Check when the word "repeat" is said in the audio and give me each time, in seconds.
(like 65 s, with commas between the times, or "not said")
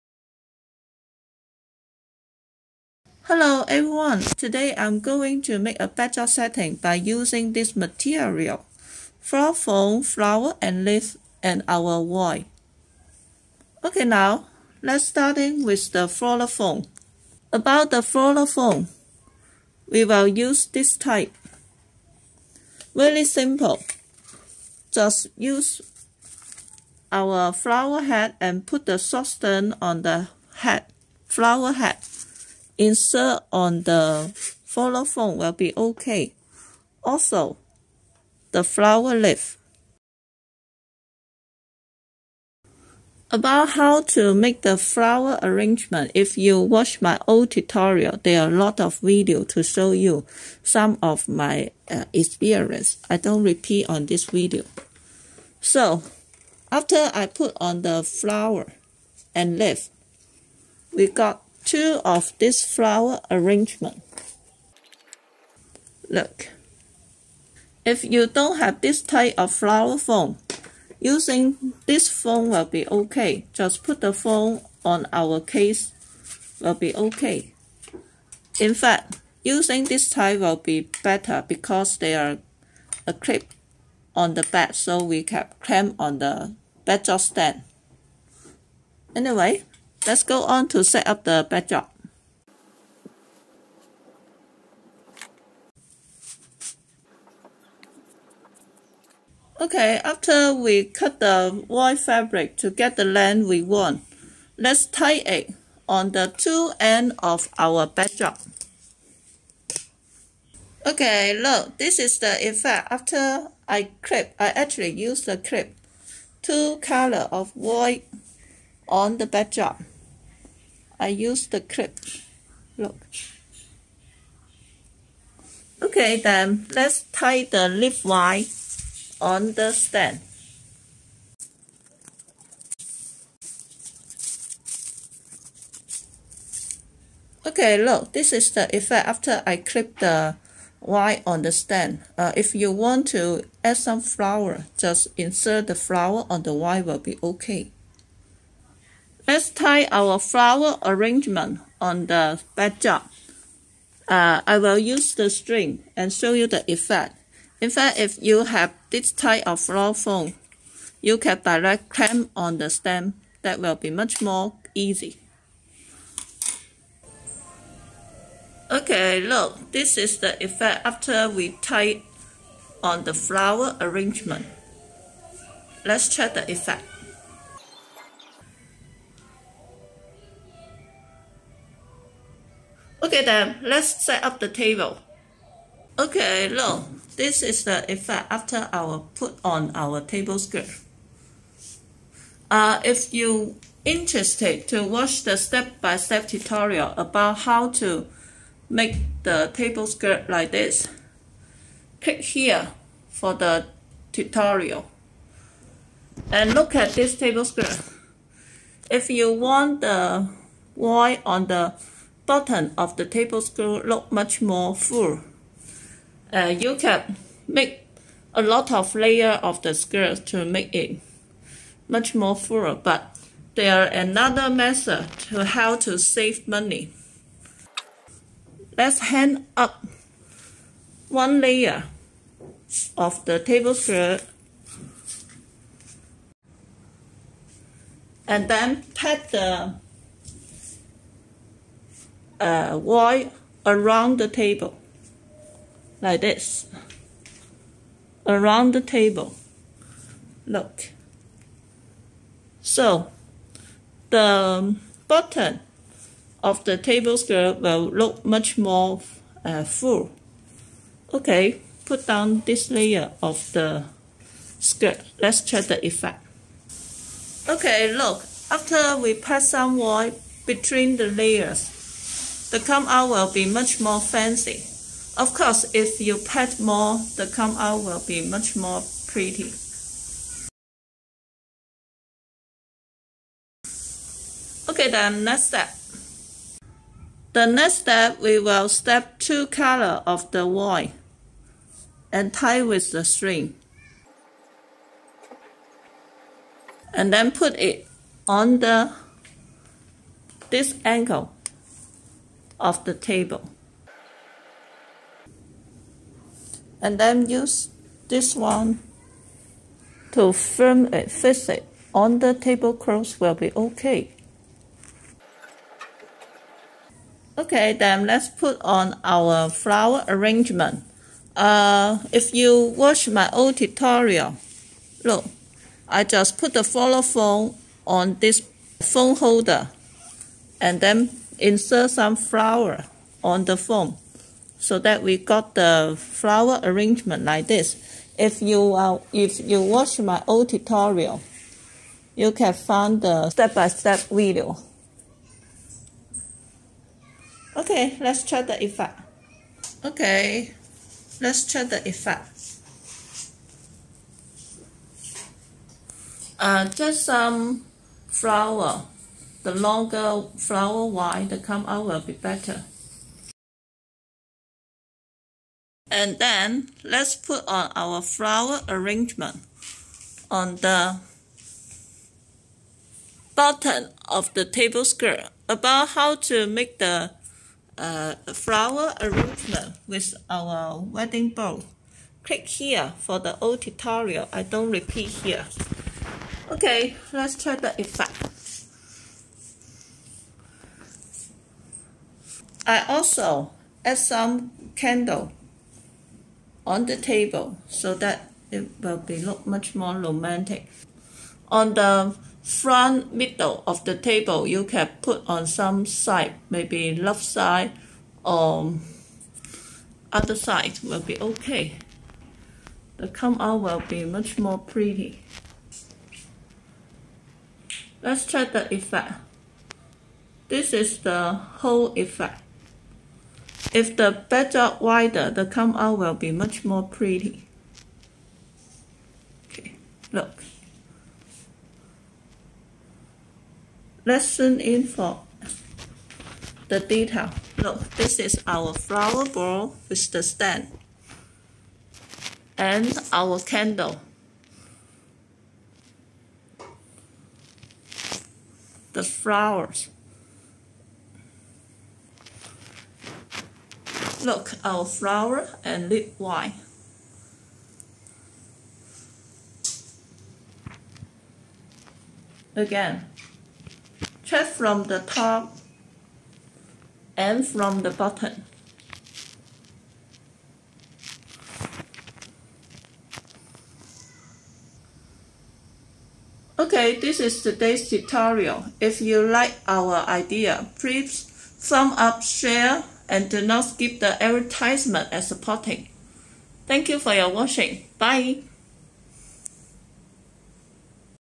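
53 s, 384 s.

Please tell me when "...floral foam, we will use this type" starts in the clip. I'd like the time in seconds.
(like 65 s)
18 s.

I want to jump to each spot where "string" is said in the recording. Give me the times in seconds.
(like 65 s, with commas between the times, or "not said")
155 s, 293 s.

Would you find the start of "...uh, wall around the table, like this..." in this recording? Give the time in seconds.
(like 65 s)
242 s.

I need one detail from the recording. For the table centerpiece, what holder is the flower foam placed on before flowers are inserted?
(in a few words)
phone holder.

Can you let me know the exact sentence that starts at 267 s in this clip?
Okay, look, after we pass some white between the layers, the come out will be much more fancy.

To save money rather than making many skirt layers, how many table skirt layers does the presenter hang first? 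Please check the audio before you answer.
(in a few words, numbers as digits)
one layer.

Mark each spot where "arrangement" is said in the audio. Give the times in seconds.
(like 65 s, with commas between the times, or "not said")
45 s, 63 s, 150 s, 173 s, 320 s, 336 s, 368 s, 379 s.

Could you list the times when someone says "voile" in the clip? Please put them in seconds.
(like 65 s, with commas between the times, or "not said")
210 s, 290 s.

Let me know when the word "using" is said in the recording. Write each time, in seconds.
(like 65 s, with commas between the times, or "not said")
6 s, 70 s, 79 s.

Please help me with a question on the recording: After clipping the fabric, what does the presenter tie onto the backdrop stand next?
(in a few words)
leaf wire.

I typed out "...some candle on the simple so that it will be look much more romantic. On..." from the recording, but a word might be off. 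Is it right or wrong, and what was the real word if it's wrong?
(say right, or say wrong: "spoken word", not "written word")
wrong: "table", not "simple".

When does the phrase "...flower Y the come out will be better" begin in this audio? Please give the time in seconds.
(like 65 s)
360 s.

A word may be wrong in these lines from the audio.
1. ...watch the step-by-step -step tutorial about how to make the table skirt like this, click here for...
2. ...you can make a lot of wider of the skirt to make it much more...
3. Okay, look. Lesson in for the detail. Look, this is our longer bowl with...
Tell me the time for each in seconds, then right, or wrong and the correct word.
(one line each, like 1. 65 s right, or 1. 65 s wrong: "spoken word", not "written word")
1. 194 s right
2. 216 s wrong: "layer", not "wider"
3. 429 s wrong: "flower", not "longer".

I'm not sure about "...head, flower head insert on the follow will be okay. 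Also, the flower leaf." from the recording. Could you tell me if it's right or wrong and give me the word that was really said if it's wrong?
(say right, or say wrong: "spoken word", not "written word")
right.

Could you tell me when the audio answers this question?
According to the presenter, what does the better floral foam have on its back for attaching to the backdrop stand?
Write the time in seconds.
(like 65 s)
83 s.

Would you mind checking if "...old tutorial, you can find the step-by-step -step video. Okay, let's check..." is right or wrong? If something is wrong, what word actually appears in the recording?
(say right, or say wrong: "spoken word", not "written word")
right.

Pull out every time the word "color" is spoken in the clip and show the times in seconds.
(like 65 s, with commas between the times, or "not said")
116 s, 289 s.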